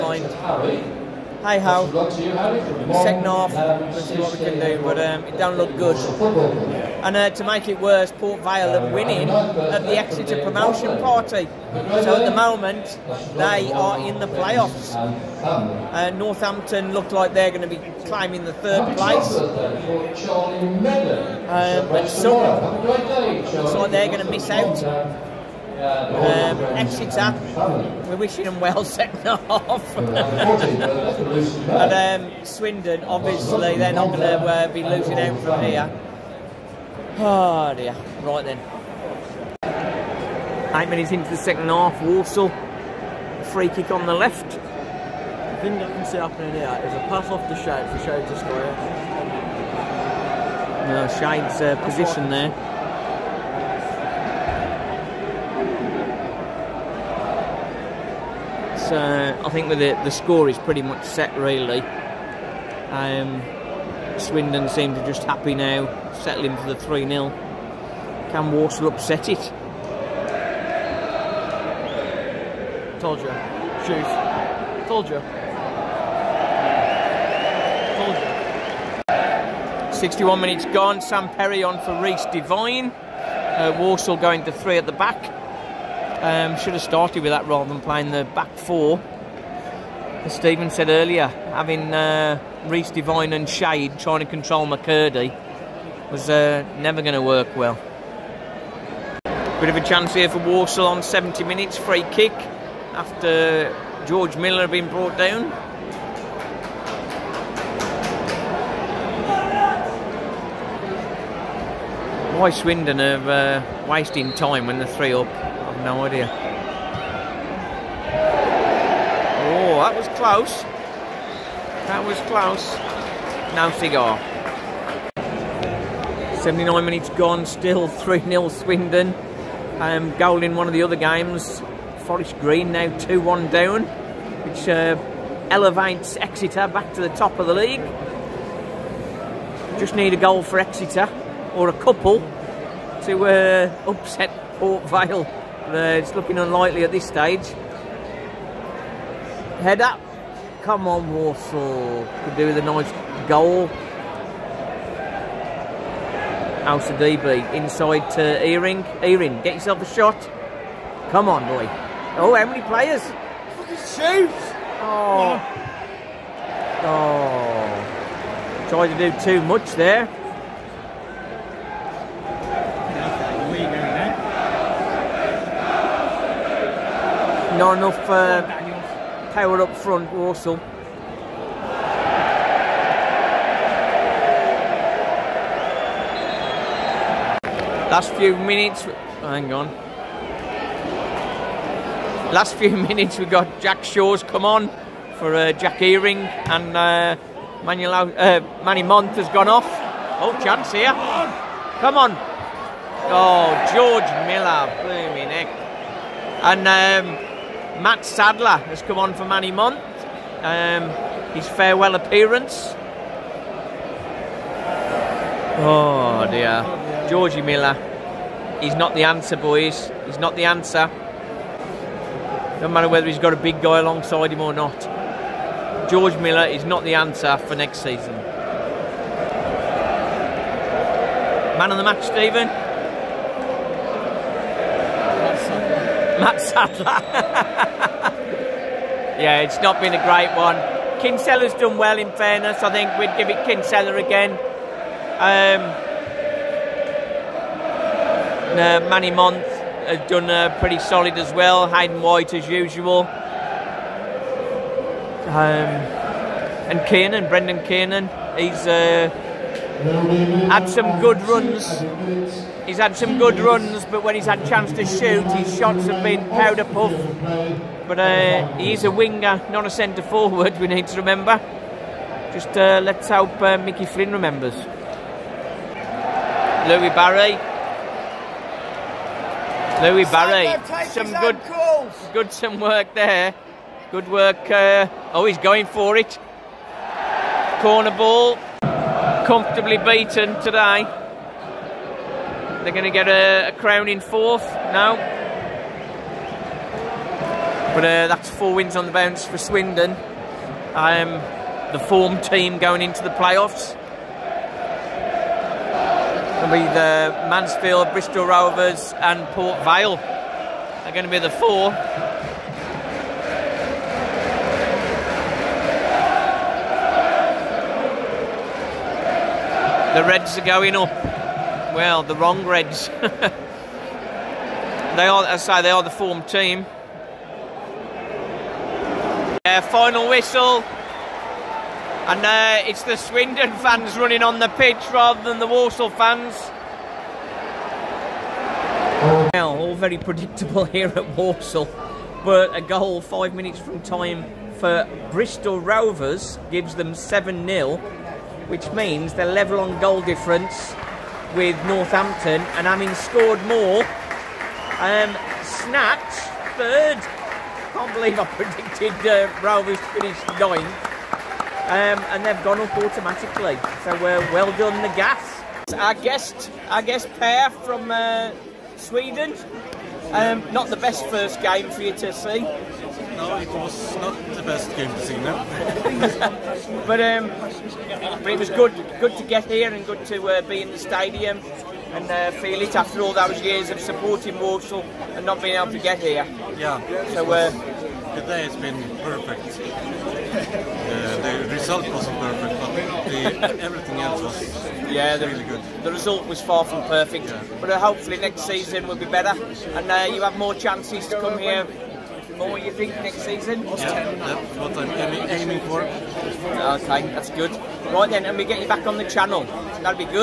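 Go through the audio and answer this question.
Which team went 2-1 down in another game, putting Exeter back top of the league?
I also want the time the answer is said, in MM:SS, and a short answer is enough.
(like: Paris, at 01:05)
Forest Green, at 02:12.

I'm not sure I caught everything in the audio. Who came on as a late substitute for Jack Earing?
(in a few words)
Jack Shaw.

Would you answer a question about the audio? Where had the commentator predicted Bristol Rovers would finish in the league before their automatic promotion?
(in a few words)
9th.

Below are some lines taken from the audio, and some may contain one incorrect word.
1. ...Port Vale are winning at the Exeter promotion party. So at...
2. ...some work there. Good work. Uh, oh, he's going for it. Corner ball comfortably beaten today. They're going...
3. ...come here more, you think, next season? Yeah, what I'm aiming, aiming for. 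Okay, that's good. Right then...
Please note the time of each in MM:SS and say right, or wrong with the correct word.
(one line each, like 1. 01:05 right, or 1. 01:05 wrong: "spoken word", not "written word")
1. 00:08 right
2. 04:42 right
3. 06:41 right.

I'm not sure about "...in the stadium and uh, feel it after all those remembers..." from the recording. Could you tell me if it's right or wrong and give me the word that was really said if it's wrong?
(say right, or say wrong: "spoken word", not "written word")
wrong: "years", not "remembers".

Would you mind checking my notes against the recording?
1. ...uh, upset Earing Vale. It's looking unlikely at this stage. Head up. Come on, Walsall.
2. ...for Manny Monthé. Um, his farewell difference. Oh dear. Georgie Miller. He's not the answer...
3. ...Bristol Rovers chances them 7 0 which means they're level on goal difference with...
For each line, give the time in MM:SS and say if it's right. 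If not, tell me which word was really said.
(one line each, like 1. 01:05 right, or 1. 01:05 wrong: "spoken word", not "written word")
1. 02:23 wrong: "Port", not "Earing"
2. 03:29 wrong: "appearance", not "difference"
3. 05:45 wrong: "gives", not "chances".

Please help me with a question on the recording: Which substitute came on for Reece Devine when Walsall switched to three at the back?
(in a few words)
Sam Perry.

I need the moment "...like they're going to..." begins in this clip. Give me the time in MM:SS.
00:17.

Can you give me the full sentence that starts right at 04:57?
But uh, that's four wins on the bounce for Swindon.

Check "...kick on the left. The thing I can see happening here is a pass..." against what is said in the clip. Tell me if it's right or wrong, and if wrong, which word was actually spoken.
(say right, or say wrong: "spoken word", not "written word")
right.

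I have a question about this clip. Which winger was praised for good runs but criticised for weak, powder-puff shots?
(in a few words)
Brendan Kiernan.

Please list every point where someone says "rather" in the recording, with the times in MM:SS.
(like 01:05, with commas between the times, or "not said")
01:27, 05:34.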